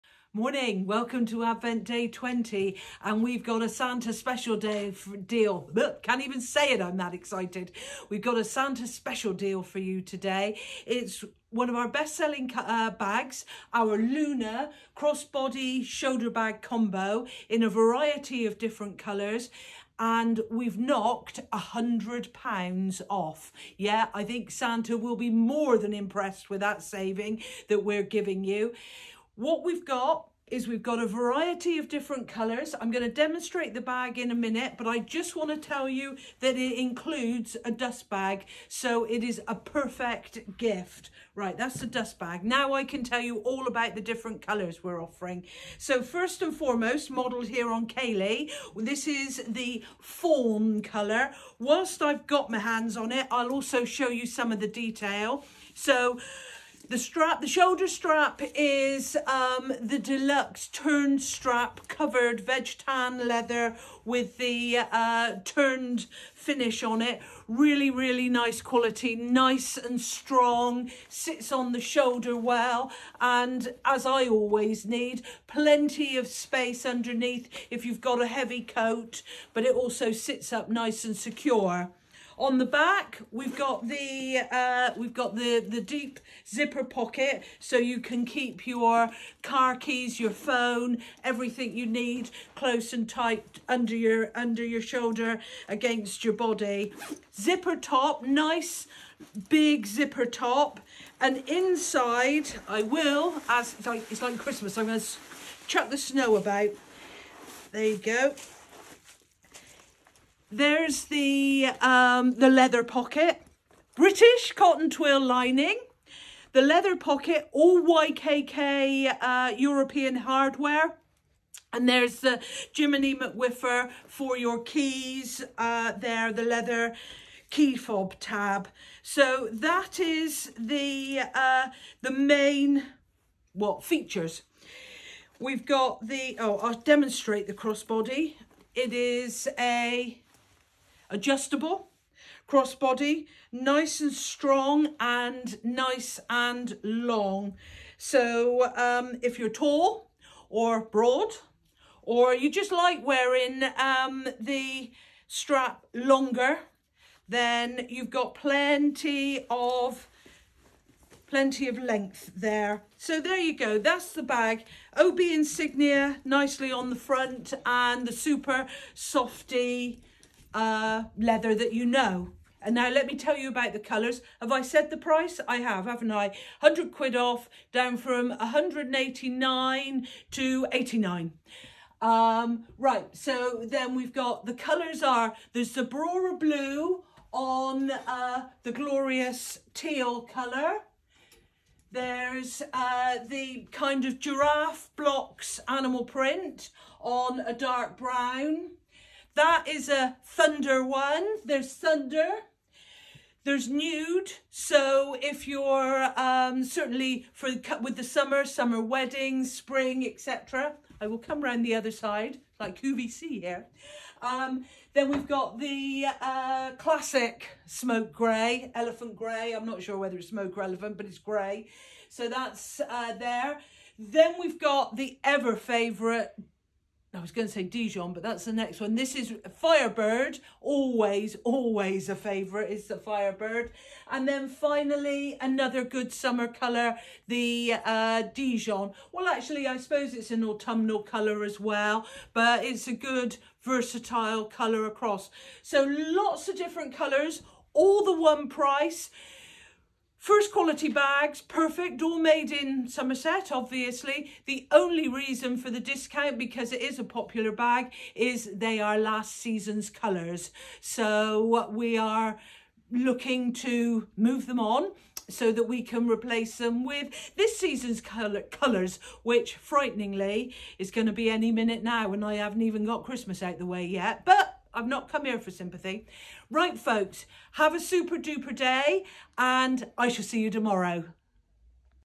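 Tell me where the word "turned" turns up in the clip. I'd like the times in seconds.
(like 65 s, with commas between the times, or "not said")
60 s, 65 s.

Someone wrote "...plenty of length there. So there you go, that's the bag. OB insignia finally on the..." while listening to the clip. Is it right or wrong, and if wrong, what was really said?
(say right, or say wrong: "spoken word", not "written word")
wrong: "nicely", not "finally".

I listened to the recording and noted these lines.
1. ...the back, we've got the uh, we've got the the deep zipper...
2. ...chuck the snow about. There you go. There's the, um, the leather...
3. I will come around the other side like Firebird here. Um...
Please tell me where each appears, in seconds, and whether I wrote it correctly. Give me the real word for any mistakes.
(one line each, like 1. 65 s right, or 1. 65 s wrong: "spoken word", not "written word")
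1. 82 s right
2. 105 s right
3. 210 s wrong: "QVC", not "Firebird".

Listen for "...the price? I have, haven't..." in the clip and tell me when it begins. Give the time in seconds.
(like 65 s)
174 s.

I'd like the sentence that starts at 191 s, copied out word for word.
There's uh, the kind of giraffe blocks animal print on a dark brown.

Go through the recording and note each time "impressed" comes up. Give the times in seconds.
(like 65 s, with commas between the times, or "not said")
25 s.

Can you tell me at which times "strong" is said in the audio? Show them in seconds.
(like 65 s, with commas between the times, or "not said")
70 s, 144 s.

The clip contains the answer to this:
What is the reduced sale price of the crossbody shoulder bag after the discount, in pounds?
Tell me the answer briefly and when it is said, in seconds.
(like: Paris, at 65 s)
89, at 180 s.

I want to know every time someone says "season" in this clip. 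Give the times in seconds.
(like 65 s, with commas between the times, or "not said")
259 s, 267 s.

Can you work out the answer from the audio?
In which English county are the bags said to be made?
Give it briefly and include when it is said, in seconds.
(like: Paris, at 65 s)
Somerset, at 252 s.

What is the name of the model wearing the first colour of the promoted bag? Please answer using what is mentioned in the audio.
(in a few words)
Kaylee.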